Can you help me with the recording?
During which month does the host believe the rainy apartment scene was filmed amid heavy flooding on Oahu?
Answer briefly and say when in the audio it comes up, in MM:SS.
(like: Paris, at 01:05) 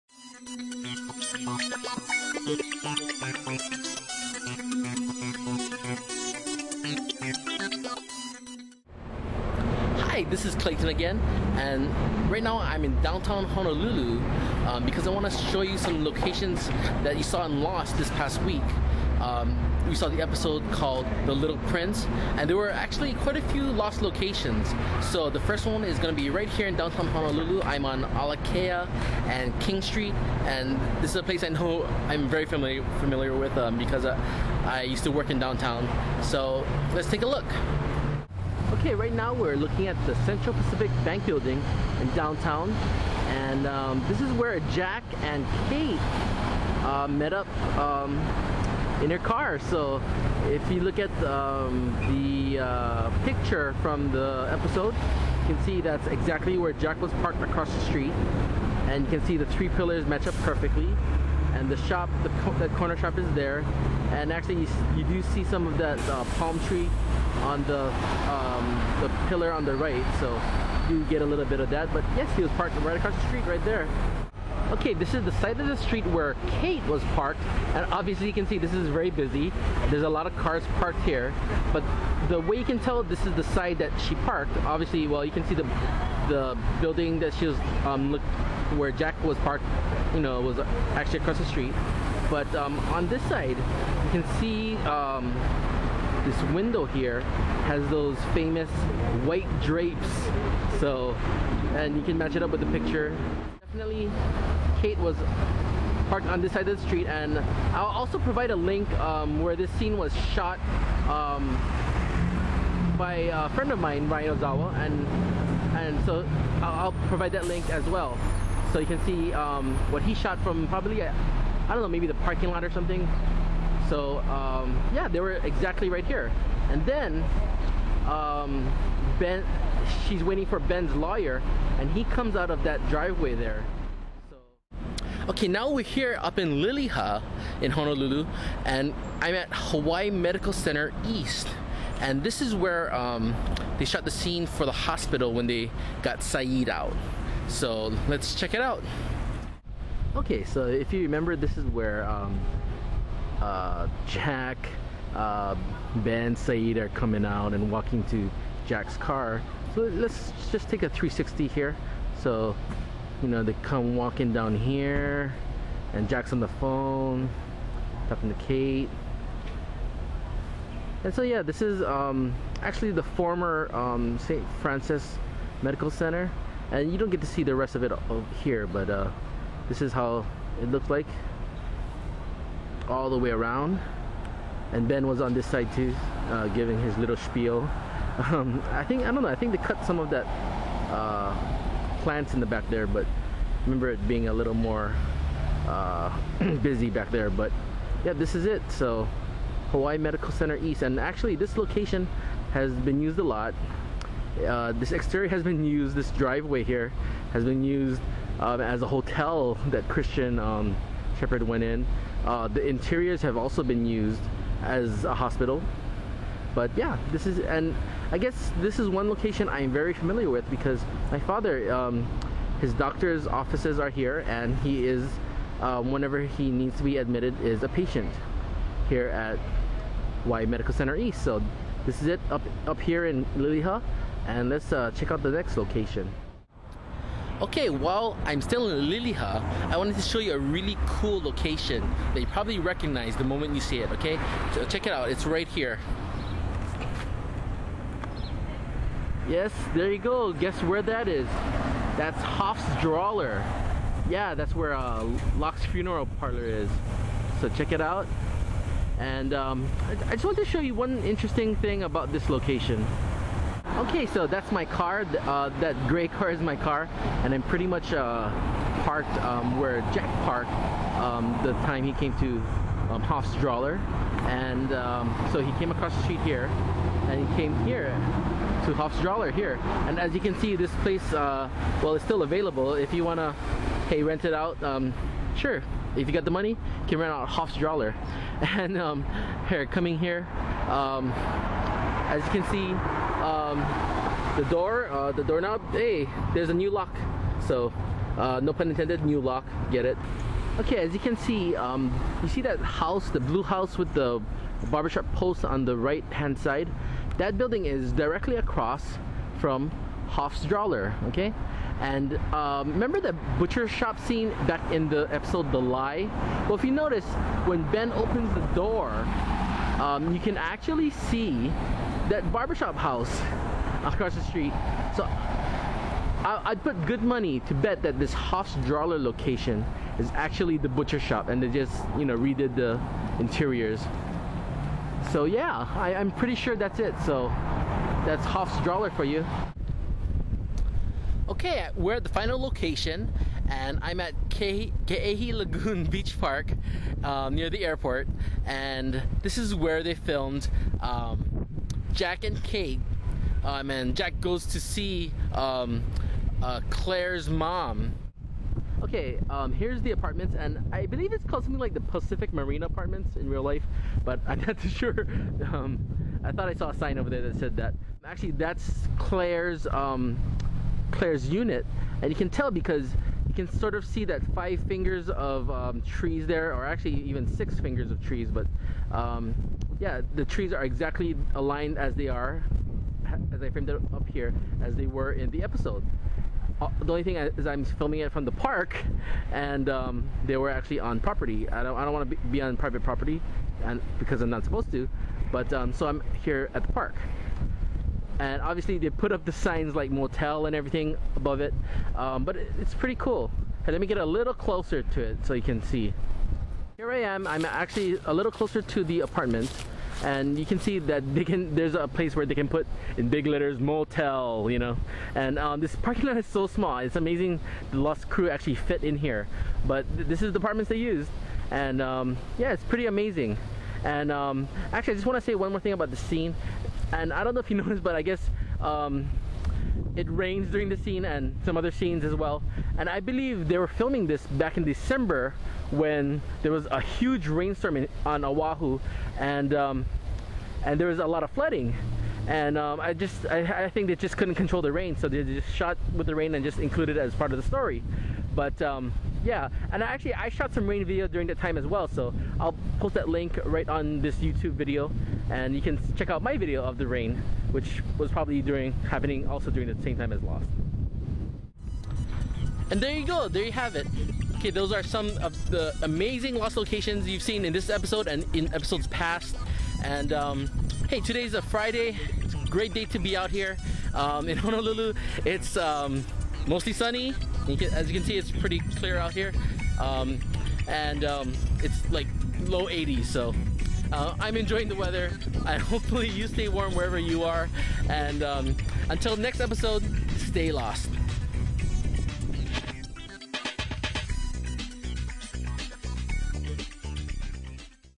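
December, at 07:14.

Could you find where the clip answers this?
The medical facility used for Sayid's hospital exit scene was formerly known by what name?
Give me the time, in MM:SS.
02:54.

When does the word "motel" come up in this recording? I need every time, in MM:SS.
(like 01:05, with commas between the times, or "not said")
06:39, 06:53.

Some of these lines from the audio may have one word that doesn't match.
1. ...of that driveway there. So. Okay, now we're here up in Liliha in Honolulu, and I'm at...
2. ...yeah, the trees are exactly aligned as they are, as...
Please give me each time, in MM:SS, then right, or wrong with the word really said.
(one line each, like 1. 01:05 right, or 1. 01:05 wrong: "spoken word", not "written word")
1. 02:12 right
2. 06:19 right.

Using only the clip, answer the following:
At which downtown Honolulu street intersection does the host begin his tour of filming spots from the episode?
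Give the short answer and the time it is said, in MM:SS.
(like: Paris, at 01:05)
Alakea and King Street, at 00:28.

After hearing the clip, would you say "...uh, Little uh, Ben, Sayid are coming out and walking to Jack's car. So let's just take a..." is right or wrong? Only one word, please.
wrong.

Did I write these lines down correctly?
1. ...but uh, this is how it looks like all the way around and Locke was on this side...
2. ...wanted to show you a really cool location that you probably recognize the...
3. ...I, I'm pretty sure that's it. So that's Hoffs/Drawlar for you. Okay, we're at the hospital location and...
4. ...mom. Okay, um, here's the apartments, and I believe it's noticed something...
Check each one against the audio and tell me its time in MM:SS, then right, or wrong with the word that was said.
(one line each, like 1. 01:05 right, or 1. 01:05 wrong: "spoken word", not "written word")
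1. 02:58 wrong: "Ben", not "Locke"
2. 03:59 right
3. 05:35 wrong: "final", not "hospital"
4. 05:57 wrong: "called", not "noticed".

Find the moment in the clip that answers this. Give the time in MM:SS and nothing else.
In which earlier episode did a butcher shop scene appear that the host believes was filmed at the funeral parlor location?
05:15.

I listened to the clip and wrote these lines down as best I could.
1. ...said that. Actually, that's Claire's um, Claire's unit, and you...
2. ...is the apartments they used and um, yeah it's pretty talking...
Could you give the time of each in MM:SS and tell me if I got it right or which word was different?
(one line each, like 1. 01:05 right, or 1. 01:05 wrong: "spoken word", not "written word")
1. 06:07 right
2. 07:00 wrong: "amazing", not "talking".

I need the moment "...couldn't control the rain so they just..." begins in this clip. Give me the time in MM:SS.
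07:24.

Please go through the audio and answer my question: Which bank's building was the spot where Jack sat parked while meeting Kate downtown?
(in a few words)
Central Pacific Bank.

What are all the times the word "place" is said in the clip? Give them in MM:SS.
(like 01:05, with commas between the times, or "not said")
00:31, 04:40, 06:51.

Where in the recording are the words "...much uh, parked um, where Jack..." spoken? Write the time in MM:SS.
04:27.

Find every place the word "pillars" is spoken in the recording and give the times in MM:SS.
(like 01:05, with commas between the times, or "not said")
00:59, 01:09.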